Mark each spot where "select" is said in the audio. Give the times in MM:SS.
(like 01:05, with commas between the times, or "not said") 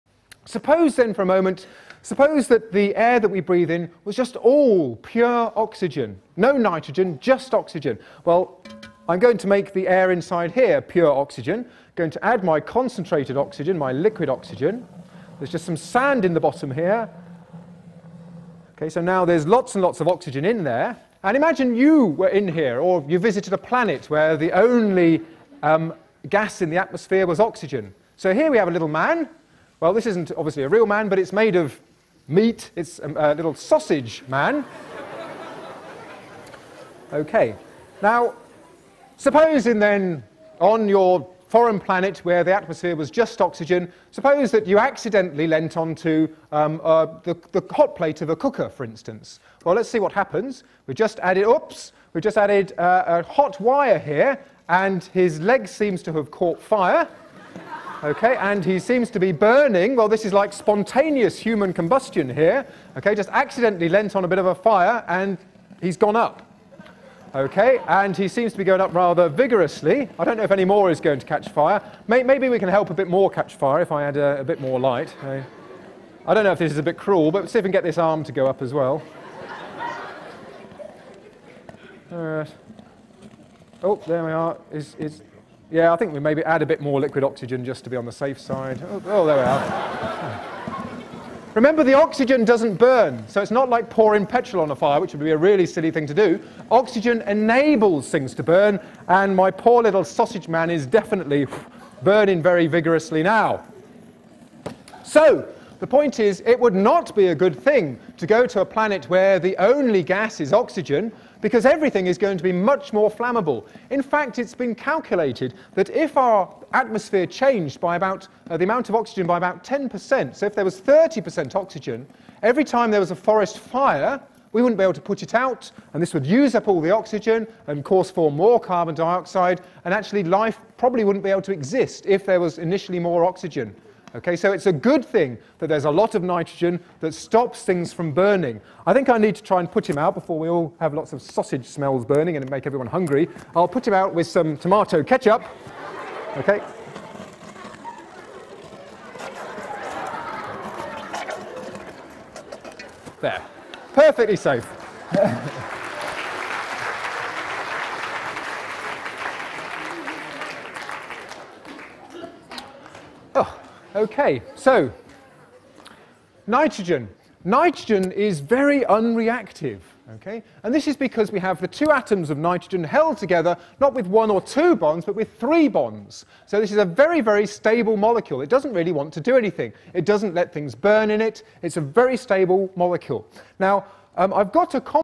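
not said.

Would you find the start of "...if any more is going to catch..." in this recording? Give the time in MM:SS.
01:10.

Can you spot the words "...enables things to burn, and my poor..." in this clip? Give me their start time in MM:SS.
01:37.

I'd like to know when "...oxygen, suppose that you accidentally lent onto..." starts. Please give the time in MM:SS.
00:43.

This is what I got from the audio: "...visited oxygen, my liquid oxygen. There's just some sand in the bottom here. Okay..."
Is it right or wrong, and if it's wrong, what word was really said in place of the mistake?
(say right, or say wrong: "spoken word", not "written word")
wrong: "concentrated", not "visited".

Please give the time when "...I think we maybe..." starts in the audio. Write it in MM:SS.
01:25.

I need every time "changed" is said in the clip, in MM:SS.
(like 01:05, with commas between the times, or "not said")
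01:57.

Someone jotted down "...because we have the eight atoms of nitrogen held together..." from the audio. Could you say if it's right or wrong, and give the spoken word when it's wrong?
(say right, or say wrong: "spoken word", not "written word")
wrong: "two", not "eight".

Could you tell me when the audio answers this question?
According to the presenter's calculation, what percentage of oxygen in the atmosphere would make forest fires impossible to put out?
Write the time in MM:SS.
02:00.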